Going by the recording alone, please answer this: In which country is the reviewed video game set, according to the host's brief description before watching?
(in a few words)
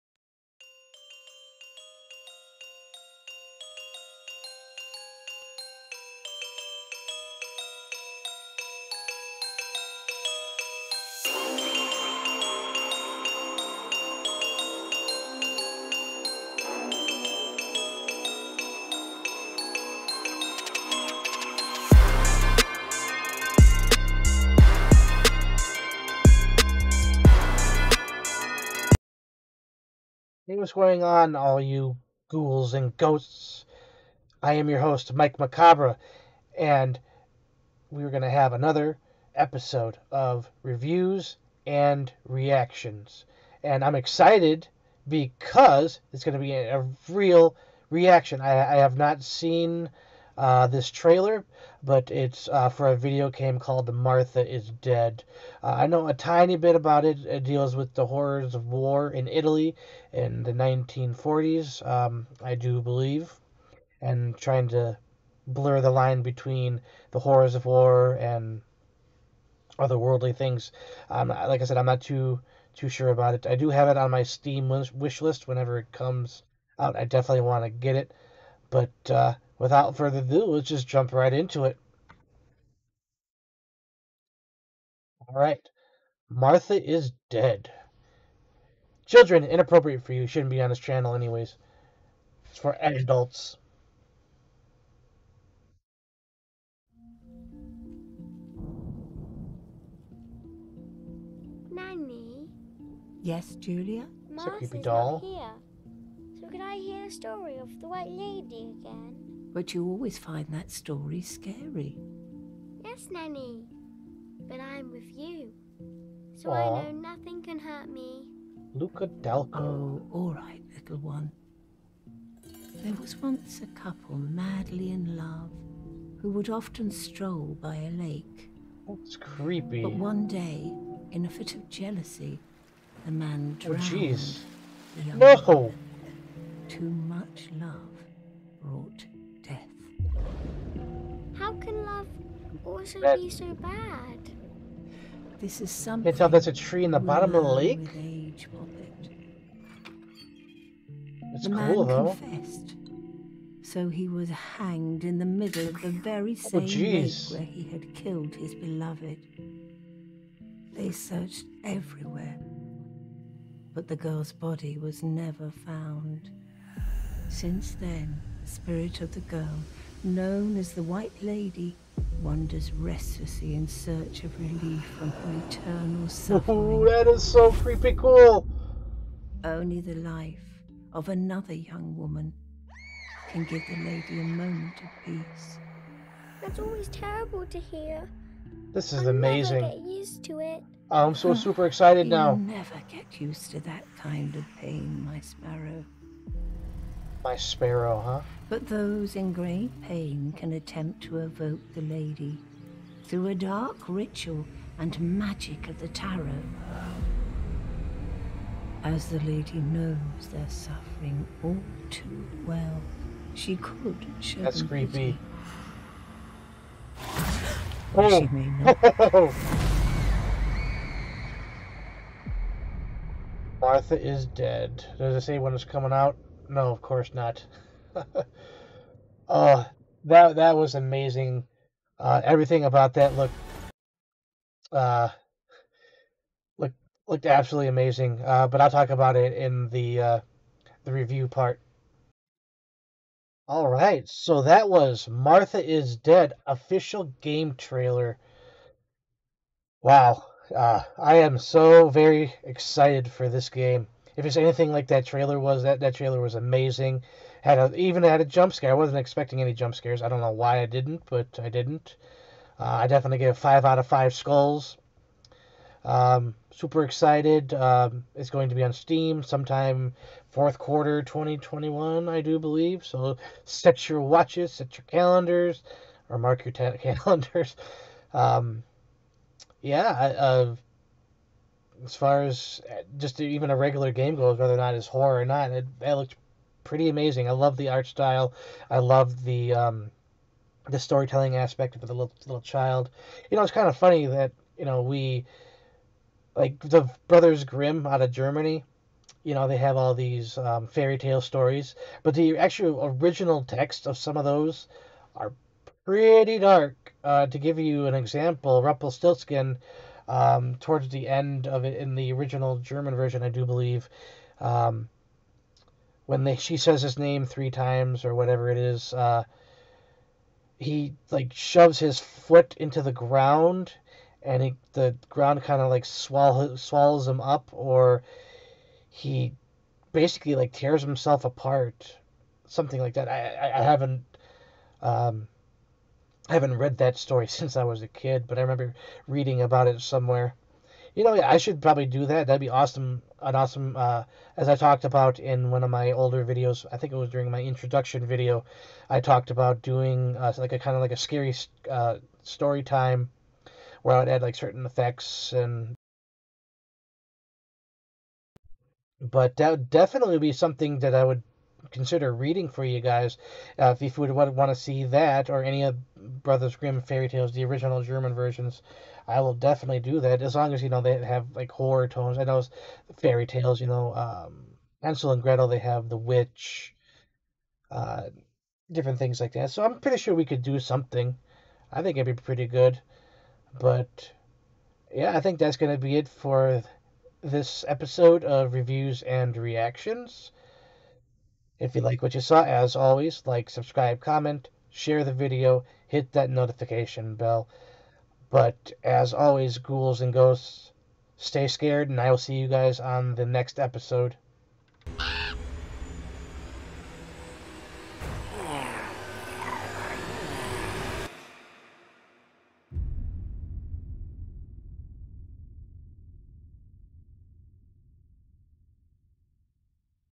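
Italy.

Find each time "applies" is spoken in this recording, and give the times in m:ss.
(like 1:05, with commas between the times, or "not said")
not said.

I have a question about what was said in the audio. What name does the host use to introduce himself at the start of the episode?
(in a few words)
Mike Macabre.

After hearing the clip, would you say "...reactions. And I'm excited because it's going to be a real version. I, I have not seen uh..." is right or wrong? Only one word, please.
wrong.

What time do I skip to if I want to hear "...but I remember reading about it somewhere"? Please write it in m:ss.
5:38.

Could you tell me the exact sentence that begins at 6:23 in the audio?
But yeah, I think that's gonna be it for this episode of reviews and reactions.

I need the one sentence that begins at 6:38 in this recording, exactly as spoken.
But as always, ghouls and ghosts, stay scared, and I will see you guys on the next episode.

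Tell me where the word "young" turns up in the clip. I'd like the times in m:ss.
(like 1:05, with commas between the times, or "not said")
3:01.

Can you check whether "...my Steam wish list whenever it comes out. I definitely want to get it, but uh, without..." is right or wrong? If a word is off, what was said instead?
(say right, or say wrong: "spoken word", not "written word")
right.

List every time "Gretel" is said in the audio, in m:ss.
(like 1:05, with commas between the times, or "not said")
6:15.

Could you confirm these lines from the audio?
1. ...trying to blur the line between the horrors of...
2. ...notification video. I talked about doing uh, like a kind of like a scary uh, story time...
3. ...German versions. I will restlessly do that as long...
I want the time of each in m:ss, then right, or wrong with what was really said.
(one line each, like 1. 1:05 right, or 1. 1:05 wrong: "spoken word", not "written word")
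1. 1:04 right
2. 5:47 wrong: "introduction", not "notification"
3. 6:07 wrong: "definitely", not "restlessly".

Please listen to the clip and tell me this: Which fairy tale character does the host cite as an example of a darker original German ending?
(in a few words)
Rumpelstiltskin.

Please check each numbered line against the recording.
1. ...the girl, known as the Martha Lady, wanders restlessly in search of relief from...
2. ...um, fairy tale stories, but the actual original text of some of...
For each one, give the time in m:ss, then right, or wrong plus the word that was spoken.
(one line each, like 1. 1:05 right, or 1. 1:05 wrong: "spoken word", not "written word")
1. 2:49 wrong: "White", not "Martha"
2. 5:00 right.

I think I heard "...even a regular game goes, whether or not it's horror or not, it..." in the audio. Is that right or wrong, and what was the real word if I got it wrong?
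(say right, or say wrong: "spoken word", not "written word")
right.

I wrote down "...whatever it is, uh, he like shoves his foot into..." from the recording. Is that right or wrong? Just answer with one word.
right.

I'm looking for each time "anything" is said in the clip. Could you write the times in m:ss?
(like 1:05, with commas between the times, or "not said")
4:14.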